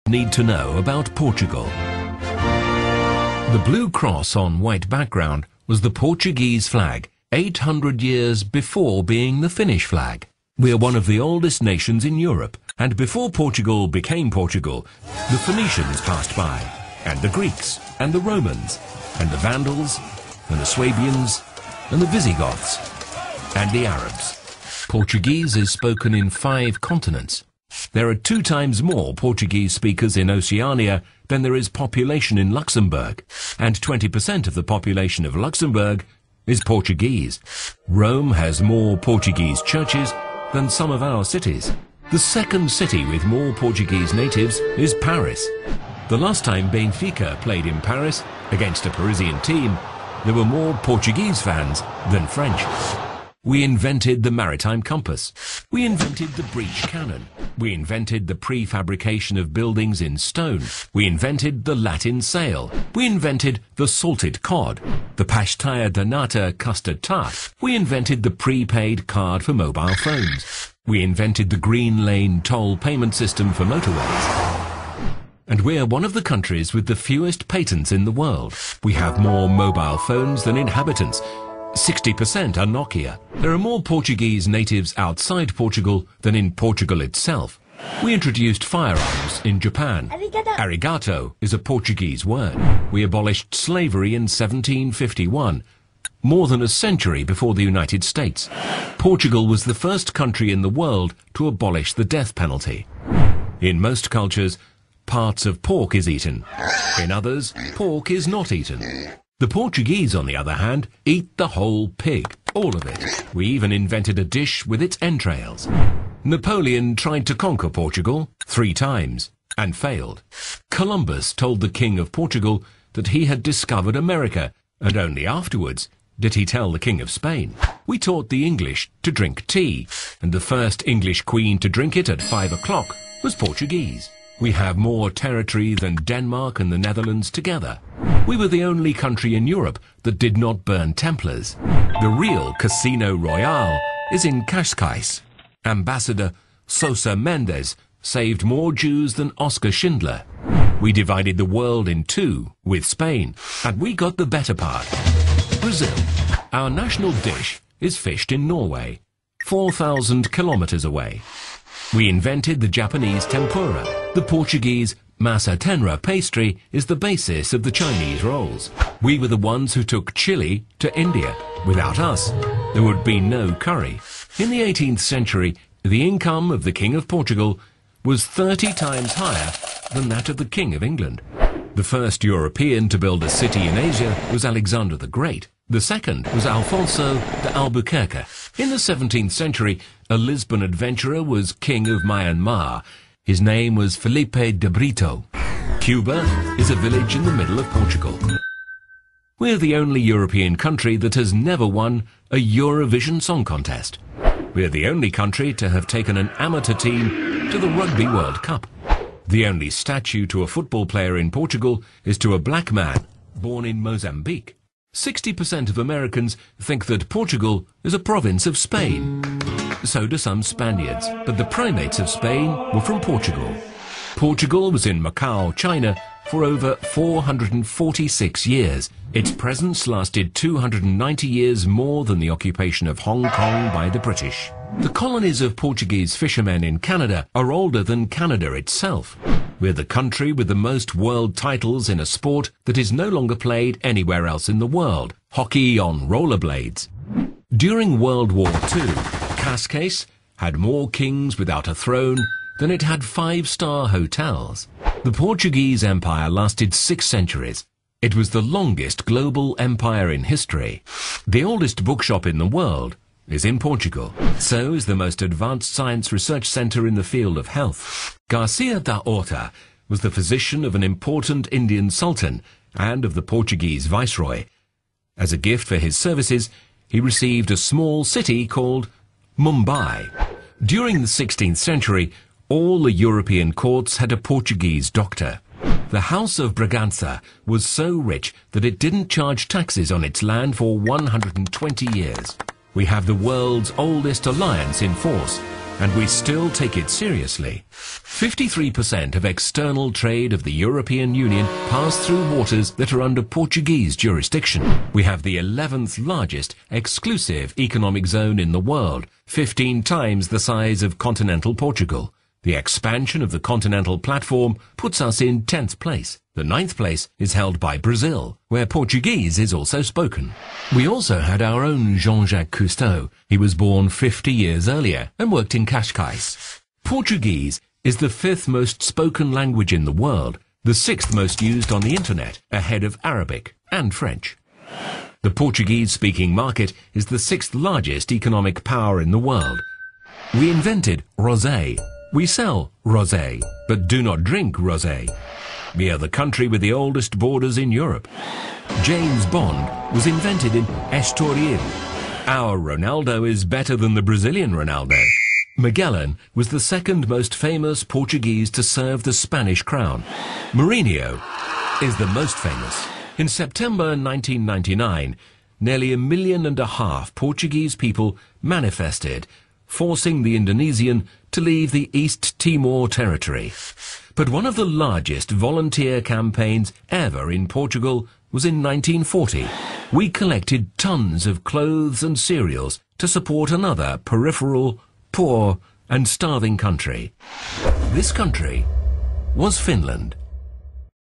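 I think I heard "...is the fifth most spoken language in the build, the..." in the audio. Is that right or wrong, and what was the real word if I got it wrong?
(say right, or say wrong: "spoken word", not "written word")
wrong: "world", not "build".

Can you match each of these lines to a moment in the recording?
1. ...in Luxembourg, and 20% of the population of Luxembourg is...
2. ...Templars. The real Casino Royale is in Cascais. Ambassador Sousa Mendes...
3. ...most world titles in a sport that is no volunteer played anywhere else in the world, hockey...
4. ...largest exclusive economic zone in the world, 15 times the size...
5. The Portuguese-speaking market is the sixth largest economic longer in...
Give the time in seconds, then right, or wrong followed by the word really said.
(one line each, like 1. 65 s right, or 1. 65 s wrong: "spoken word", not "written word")
1. 32 s right
2. 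140 s right
3. 240 s wrong: "longer", not "volunteer"
4. 306 s right
5. 335 s wrong: "power", not "longer".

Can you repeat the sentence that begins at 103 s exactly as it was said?
In most cultures, parts of pork is eaten.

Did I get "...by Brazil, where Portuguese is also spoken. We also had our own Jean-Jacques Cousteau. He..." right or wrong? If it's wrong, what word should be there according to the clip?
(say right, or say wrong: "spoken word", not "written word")
right.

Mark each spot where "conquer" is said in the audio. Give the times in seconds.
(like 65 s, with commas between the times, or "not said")
117 s.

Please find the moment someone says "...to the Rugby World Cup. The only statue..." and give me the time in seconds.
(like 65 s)
207 s.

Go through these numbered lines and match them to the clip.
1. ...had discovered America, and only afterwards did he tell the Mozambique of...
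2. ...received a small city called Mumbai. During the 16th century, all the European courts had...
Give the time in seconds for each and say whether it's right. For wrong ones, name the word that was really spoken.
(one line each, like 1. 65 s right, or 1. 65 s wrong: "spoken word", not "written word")
1. 123 s wrong: "King", not "Mozambique"
2. 276 s right.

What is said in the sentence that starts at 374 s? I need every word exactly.
But one of the largest volunteer campaigns ever in Portugal was in 1940.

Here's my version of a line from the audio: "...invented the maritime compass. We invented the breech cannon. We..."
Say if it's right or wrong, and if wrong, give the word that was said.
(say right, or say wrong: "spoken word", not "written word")
right.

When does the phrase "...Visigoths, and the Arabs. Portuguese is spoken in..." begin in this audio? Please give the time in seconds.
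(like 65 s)
22 s.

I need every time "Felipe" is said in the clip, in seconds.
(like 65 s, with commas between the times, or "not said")
193 s.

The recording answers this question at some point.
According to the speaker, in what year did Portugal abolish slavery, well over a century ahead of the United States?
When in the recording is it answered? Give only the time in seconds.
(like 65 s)
94 s.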